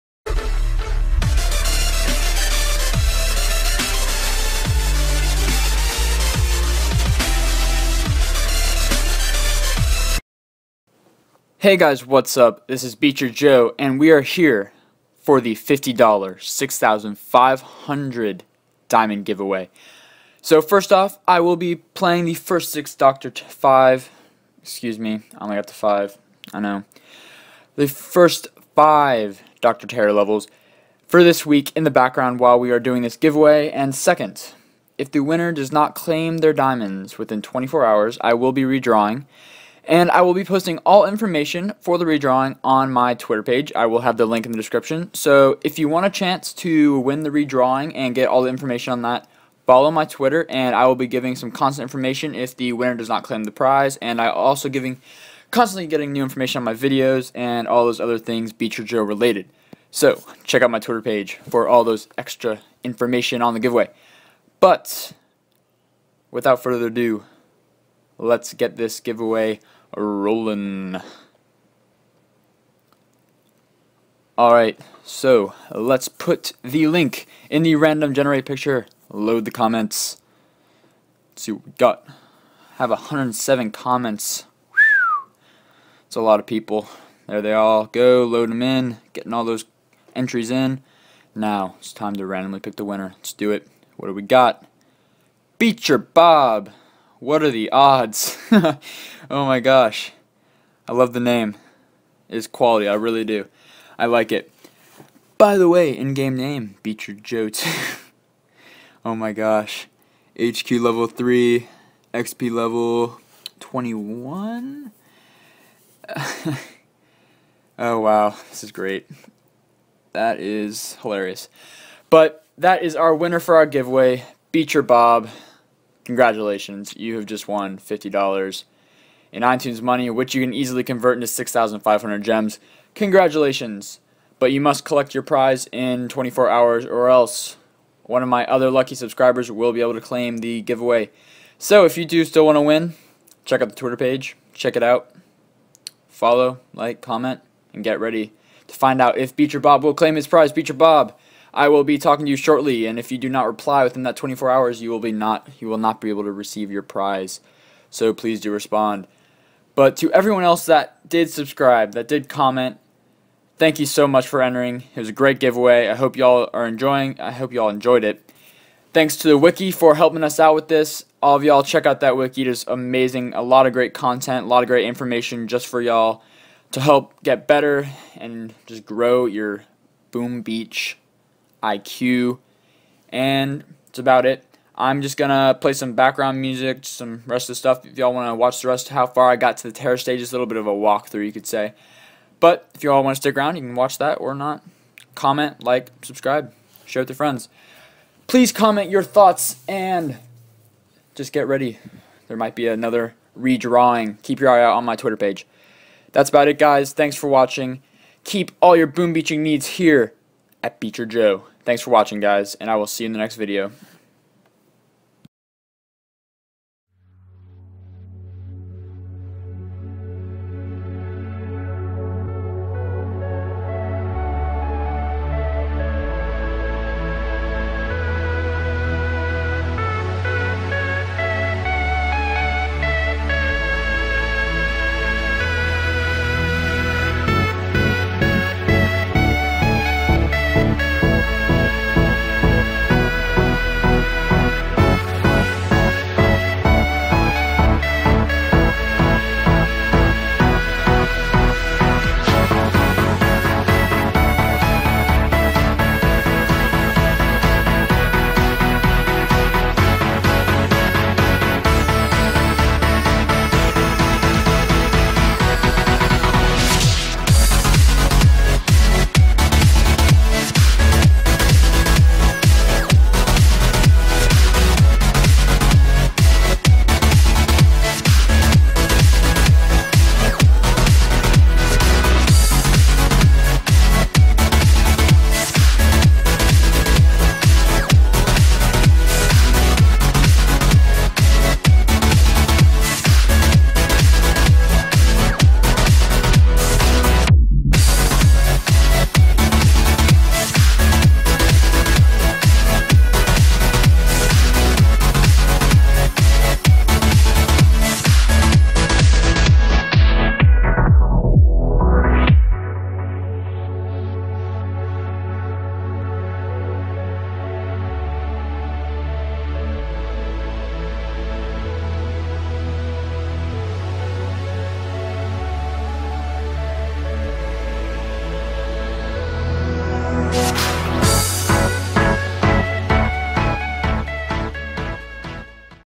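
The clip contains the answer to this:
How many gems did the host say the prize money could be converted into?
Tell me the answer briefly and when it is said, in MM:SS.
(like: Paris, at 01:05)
6,500, at 02:11.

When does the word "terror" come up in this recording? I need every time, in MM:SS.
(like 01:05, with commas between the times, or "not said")
00:29, 03:09.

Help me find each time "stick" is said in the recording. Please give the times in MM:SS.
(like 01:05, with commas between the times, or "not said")
03:13.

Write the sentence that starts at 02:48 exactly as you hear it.
Thanks to the wiki for helping us out with this.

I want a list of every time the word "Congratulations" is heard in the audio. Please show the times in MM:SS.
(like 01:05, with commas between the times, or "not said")
02:06, 02:12.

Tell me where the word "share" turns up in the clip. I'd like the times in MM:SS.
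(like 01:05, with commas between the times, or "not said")
03:16.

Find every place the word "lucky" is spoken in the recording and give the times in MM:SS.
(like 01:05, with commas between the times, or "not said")
02:18.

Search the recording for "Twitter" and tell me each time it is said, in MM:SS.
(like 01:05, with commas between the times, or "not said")
00:43, 00:50, 01:00, 02:23, 03:24.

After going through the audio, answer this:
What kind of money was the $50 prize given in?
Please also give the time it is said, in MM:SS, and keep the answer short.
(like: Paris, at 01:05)
iTunes, at 02:09.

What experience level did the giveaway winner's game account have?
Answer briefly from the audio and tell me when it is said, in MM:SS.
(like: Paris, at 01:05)
21, at 01:52.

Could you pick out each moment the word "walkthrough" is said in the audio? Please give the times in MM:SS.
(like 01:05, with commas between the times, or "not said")
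03:10.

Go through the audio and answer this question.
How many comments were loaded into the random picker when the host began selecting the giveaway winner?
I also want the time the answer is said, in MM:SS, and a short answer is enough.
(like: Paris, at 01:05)
107, at 01:22.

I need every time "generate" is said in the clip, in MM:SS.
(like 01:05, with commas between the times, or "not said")
01:18.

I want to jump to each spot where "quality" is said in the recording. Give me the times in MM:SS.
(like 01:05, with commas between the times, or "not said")
01:42.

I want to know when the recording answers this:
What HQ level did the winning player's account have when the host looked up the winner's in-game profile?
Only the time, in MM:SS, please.
01:50.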